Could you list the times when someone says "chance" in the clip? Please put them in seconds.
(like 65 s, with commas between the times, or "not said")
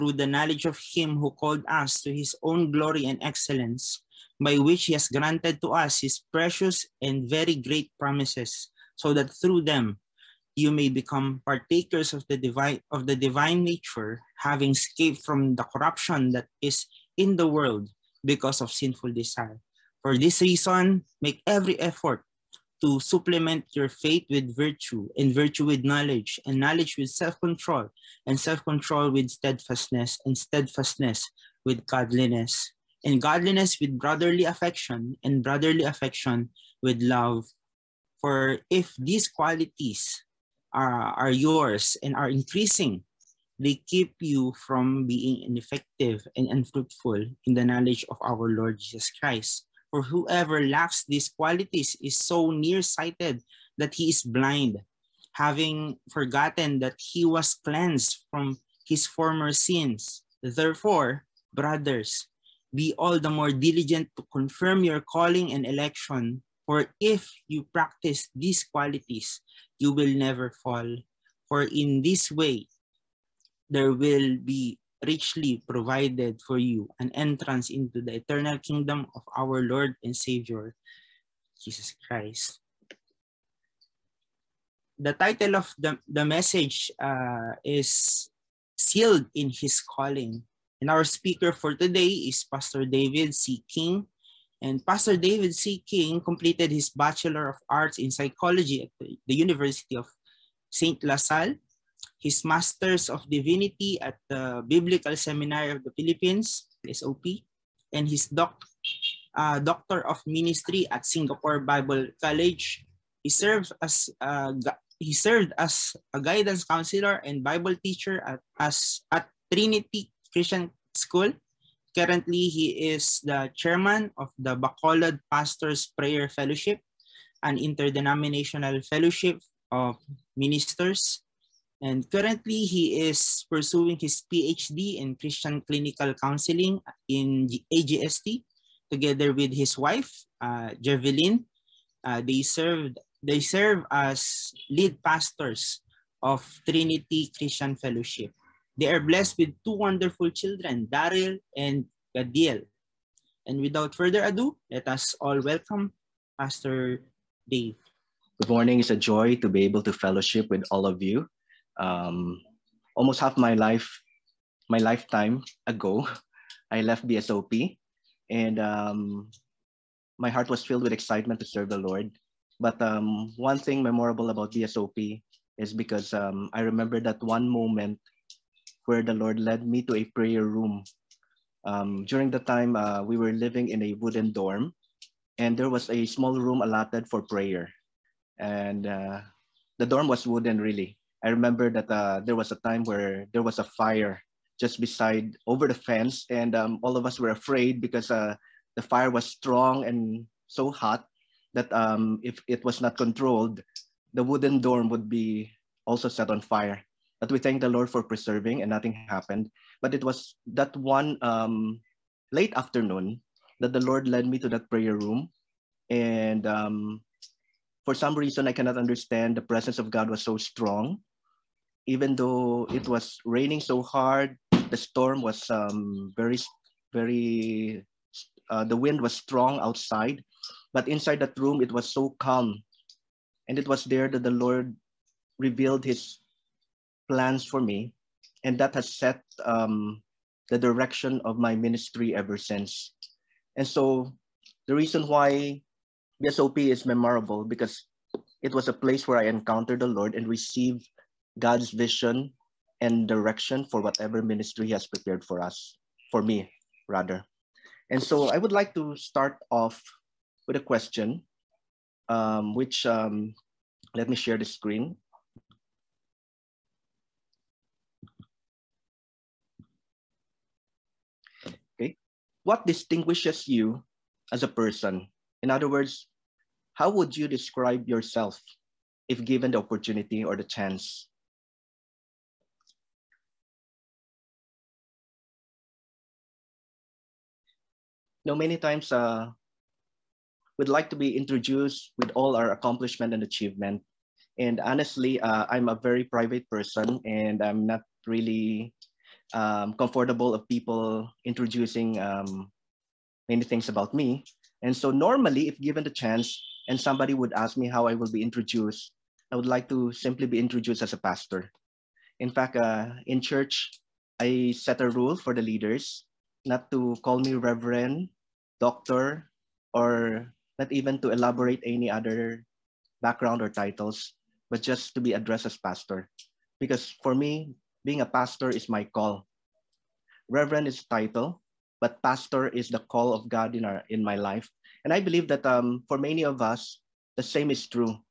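280 s, 305 s.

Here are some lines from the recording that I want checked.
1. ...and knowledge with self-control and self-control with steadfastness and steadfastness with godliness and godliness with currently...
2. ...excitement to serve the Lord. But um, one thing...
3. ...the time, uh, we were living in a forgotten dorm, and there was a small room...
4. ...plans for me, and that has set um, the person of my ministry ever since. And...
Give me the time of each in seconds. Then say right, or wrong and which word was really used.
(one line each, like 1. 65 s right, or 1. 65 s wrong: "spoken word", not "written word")
1. 26 s wrong: "brotherly", not "currently"
2. 170 s right
3. 182 s wrong: "wooden", not "forgotten"
4. 237 s wrong: "direction", not "person".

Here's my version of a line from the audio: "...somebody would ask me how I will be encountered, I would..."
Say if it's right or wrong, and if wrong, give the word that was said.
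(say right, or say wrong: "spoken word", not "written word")
wrong: "introduced", not "encountered".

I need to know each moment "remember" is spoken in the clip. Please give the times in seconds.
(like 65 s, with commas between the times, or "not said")
176 s, 191 s.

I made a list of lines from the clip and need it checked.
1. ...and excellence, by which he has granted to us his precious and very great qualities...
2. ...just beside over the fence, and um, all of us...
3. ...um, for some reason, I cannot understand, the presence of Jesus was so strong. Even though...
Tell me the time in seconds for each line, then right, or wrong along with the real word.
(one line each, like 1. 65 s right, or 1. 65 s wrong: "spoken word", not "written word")
1. 3 s wrong: "promises", not "qualities"
2. 194 s right
3. 216 s wrong: "God", not "Jesus".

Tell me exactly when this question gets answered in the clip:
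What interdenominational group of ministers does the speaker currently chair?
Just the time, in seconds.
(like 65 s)
124 s.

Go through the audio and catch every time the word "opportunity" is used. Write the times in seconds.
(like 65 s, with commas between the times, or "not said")
279 s.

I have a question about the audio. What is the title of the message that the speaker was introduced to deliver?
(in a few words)
Sealed in His Calling.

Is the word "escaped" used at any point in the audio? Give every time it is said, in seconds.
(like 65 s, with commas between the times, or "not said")
14 s.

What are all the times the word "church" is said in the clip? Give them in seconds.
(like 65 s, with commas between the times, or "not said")
313 s.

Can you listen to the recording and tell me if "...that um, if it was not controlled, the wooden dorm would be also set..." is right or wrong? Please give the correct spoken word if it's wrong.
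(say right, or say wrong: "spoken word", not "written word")
right.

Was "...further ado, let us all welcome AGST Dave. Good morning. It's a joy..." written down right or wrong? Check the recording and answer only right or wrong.
wrong.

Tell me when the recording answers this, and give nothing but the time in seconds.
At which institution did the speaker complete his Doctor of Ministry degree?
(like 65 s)
111 s.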